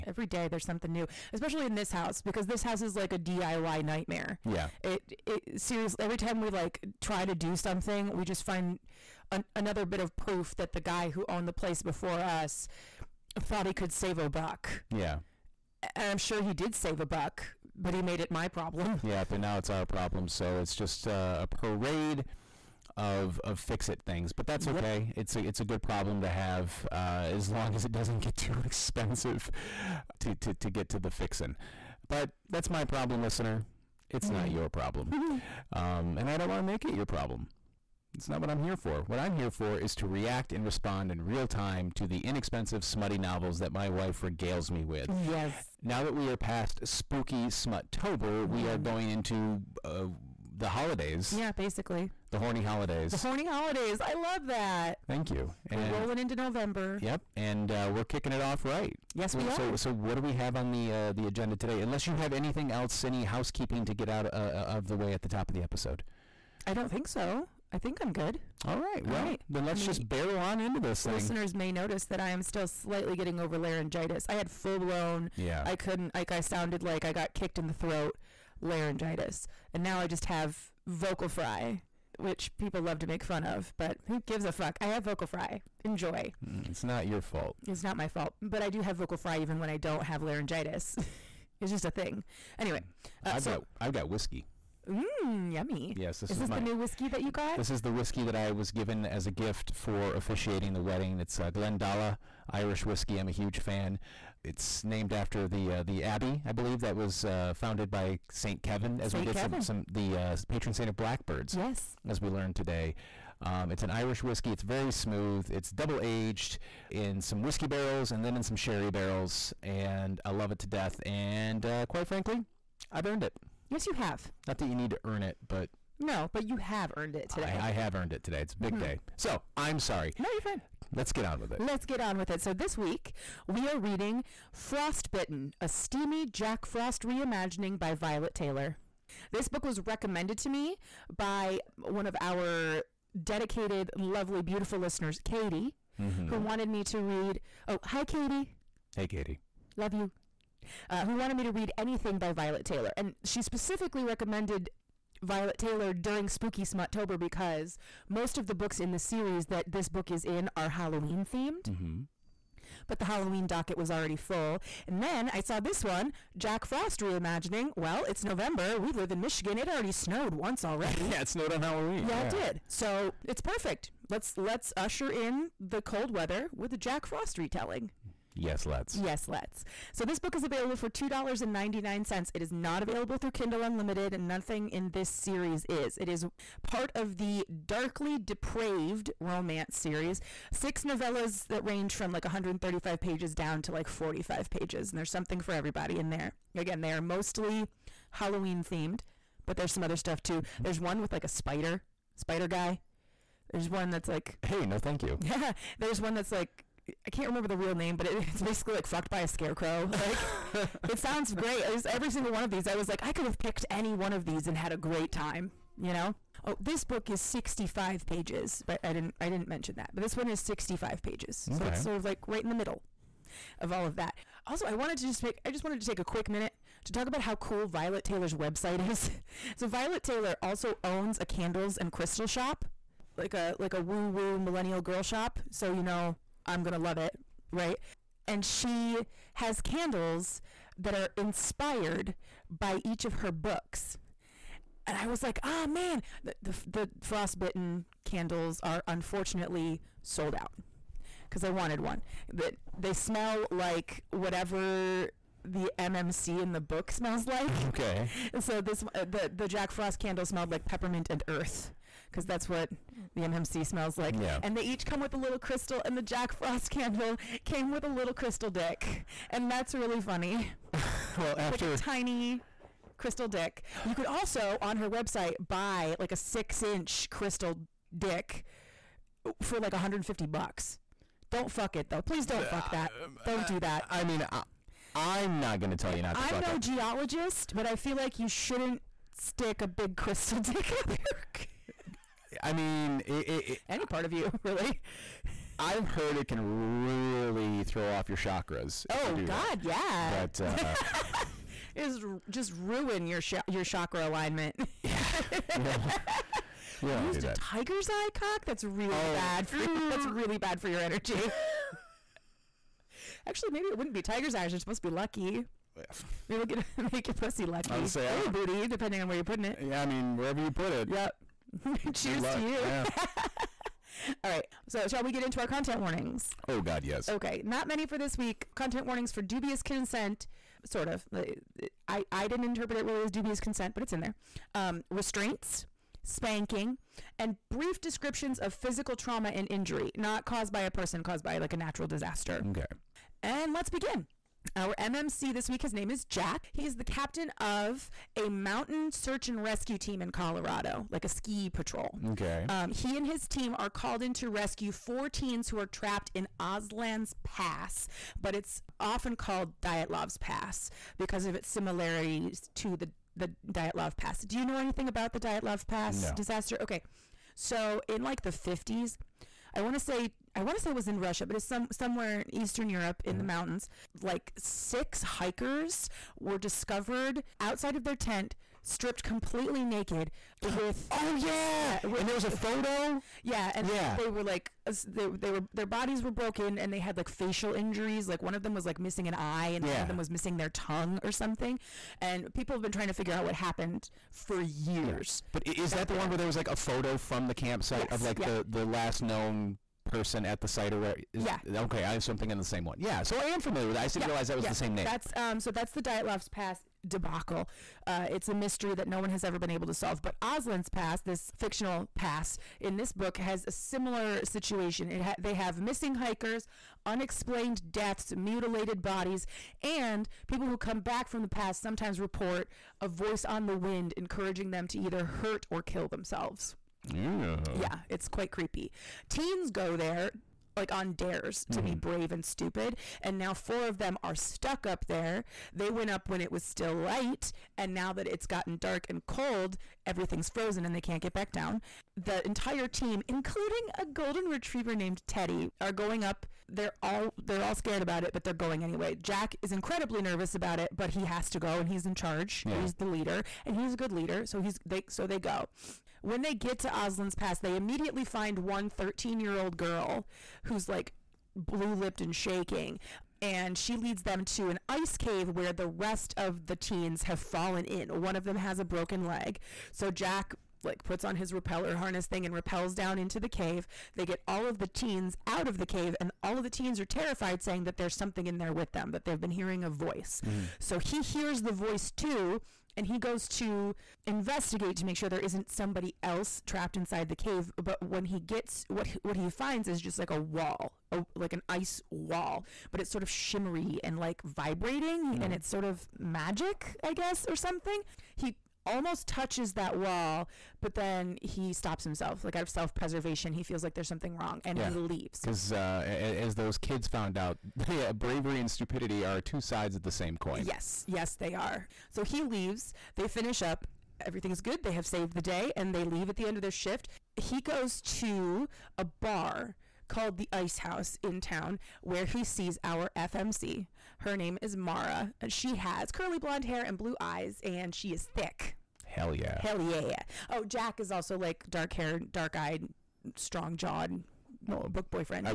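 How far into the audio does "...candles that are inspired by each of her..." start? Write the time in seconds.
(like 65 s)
239 s.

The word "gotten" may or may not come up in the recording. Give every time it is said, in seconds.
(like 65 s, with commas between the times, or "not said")
438 s.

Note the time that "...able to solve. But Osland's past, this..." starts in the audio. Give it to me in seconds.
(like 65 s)
409 s.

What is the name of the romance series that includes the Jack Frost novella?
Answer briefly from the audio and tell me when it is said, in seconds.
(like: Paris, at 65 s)
Darkly Depraved, at 187 s.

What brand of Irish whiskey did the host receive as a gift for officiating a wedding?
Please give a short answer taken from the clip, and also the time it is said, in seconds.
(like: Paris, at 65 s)
Glendalough, at 101 s.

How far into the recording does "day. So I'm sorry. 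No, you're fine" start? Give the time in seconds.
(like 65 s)
128 s.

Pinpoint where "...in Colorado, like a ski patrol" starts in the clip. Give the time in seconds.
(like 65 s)
350 s.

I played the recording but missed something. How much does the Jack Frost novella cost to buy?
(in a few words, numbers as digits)
$2.99.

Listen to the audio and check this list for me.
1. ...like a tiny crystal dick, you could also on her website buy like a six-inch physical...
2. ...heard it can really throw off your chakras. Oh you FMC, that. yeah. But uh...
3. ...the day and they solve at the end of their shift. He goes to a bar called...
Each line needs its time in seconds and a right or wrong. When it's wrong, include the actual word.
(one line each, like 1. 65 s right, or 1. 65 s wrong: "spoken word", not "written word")
1. 271 s wrong: "crystal", not "physical"
2. 295 s wrong: "God", not "FMC"
3. 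515 s wrong: "leave", not "solve".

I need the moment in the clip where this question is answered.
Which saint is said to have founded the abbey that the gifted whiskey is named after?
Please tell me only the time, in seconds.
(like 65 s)
108 s.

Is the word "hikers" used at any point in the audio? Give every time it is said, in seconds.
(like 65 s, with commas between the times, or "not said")
375 s, 415 s.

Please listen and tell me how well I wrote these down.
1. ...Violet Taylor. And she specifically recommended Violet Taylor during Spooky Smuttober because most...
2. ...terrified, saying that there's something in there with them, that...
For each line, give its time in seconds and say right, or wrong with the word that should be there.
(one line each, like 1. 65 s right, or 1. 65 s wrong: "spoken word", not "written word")
1. 152 s right
2. 476 s right.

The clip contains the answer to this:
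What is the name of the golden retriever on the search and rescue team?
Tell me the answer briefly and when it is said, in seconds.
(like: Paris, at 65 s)
Teddy, at 445 s.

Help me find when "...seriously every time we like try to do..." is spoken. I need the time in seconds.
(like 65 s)
5 s.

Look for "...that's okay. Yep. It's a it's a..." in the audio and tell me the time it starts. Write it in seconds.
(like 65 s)
24 s.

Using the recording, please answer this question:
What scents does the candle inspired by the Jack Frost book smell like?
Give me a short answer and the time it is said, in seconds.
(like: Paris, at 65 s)
peppermint and earth, at 260 s.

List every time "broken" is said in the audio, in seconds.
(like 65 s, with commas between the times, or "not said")
386 s, 468 s.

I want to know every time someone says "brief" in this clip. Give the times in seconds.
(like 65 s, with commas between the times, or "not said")
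337 s.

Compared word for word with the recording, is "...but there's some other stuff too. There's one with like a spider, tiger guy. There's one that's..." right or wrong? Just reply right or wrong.
wrong.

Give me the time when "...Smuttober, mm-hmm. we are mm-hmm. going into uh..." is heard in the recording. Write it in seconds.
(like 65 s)
47 s.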